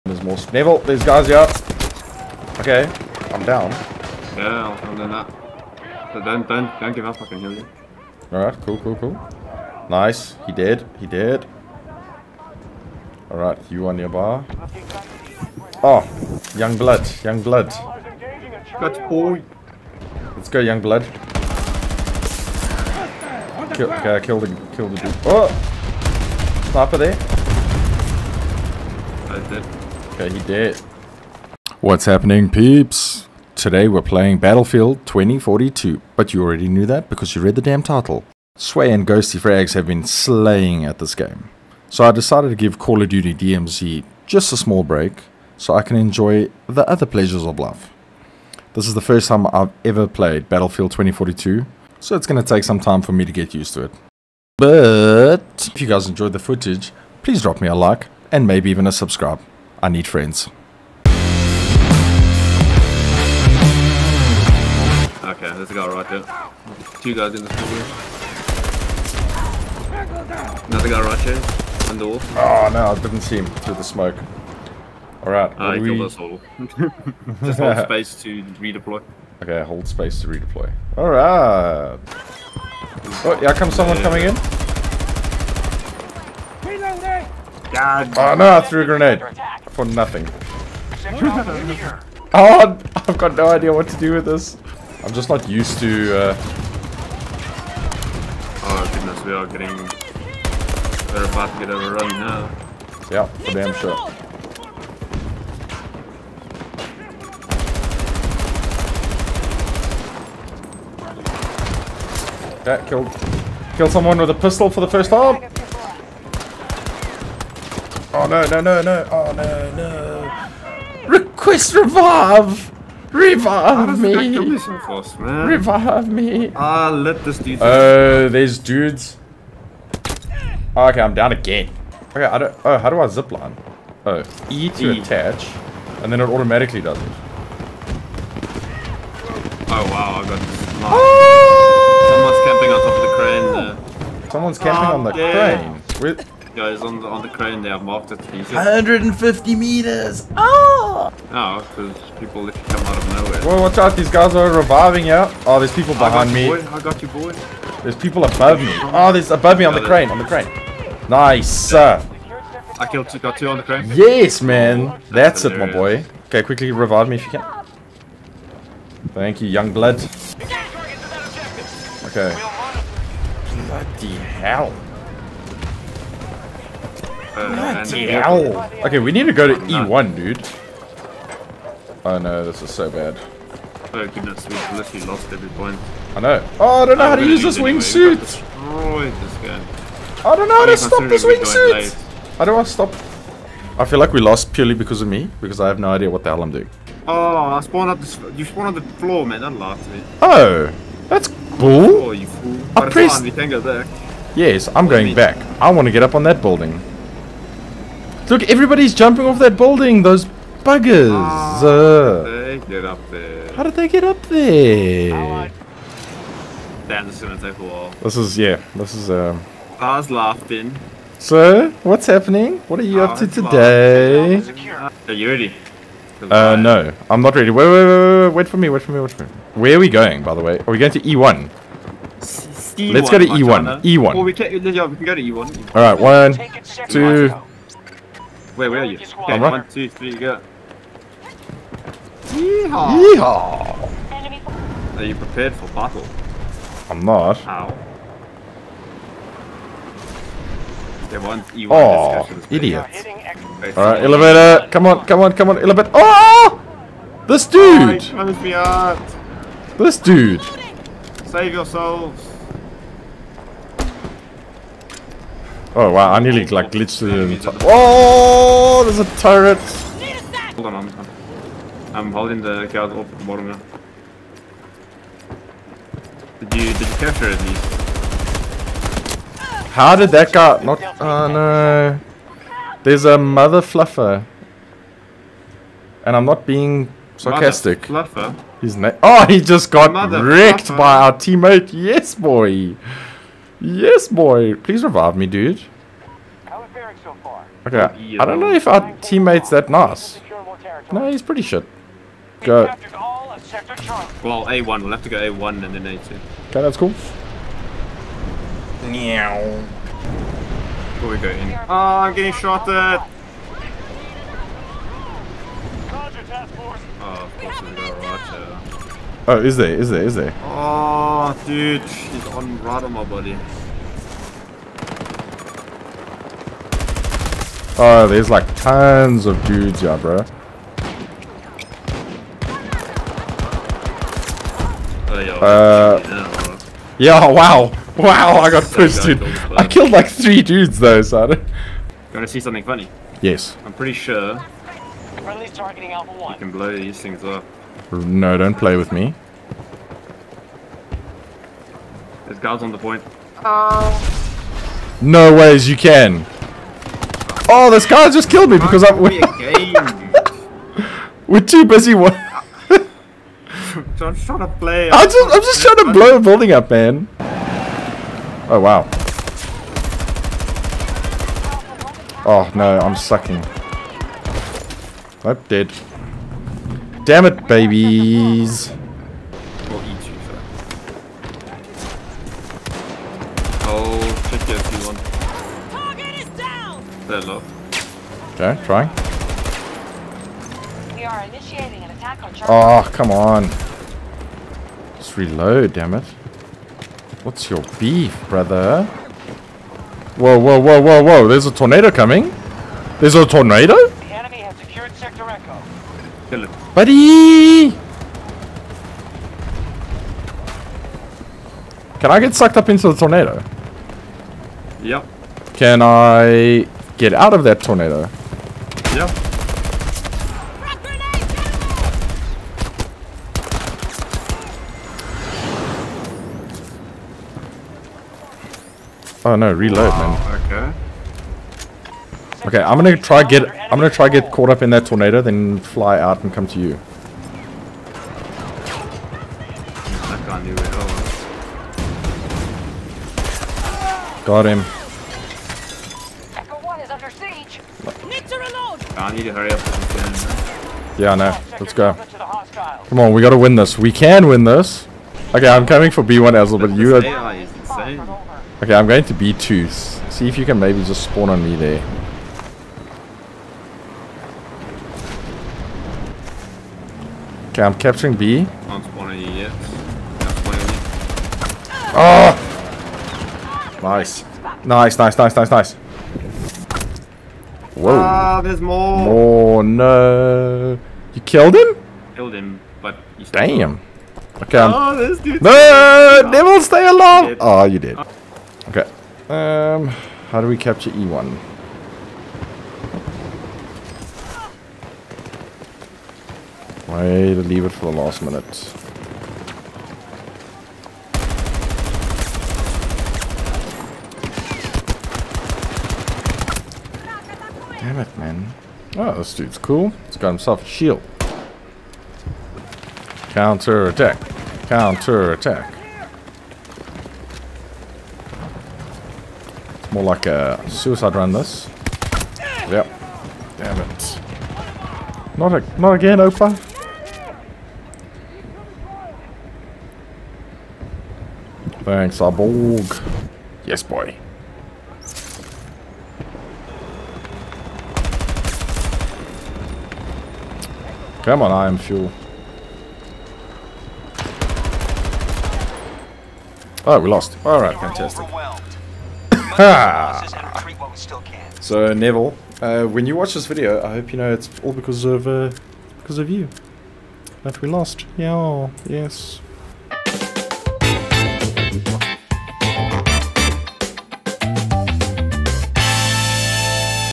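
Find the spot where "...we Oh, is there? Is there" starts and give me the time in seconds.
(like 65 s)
317 s.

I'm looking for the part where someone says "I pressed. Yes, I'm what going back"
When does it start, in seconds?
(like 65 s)
202 s.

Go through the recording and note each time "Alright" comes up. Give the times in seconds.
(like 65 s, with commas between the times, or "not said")
8 s, 13 s, 75 s, 80 s, 235 s, 253 s, 547 s.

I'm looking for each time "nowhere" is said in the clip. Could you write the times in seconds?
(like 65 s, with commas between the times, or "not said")
153 s.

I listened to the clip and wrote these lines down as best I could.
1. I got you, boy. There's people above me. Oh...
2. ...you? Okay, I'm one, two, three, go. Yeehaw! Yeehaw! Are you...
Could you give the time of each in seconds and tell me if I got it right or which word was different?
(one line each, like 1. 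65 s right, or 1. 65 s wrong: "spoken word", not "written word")
1. 156 s right
2. 238 s right.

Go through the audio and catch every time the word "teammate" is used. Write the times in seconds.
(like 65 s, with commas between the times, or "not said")
291 s, 299 s.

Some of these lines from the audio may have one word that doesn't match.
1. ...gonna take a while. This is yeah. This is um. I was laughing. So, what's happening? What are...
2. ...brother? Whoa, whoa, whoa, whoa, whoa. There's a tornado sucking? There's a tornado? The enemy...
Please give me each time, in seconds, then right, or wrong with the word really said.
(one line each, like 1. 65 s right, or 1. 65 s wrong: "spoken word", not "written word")
1. 217 s right
2. 398 s wrong: "coming", not "sucking".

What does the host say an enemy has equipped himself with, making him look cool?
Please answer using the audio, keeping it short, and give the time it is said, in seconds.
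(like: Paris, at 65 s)
A shield, at 510 s.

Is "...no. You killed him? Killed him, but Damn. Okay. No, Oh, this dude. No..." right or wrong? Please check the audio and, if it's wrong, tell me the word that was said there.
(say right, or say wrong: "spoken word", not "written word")
right.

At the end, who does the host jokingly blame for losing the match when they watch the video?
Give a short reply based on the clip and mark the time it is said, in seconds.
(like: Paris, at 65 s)
Neville, at 551 s.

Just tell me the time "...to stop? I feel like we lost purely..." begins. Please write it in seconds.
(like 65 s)
192 s.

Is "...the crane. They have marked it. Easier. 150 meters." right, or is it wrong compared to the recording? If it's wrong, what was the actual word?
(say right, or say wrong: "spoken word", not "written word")
right.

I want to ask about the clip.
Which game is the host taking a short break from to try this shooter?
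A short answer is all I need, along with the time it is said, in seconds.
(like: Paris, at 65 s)
Call of Duty DMZ, at 42 s.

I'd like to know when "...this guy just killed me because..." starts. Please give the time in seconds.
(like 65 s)
357 s.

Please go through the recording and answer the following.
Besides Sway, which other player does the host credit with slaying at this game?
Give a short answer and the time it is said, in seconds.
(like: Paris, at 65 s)
Ghosty Frags, at 39 s.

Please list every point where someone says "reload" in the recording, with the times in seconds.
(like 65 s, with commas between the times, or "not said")
395 s, 429 s.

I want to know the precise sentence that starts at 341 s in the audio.
You want to see something funny?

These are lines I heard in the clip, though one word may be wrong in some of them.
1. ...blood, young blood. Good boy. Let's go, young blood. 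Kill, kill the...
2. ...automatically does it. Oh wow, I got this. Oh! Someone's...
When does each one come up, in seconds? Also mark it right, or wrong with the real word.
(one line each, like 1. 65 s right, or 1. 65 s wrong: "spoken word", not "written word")
1. 16 s right
2. 136 s right.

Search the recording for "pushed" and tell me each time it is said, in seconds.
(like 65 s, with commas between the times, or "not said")
338 s.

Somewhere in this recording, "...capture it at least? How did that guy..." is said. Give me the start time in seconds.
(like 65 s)
276 s.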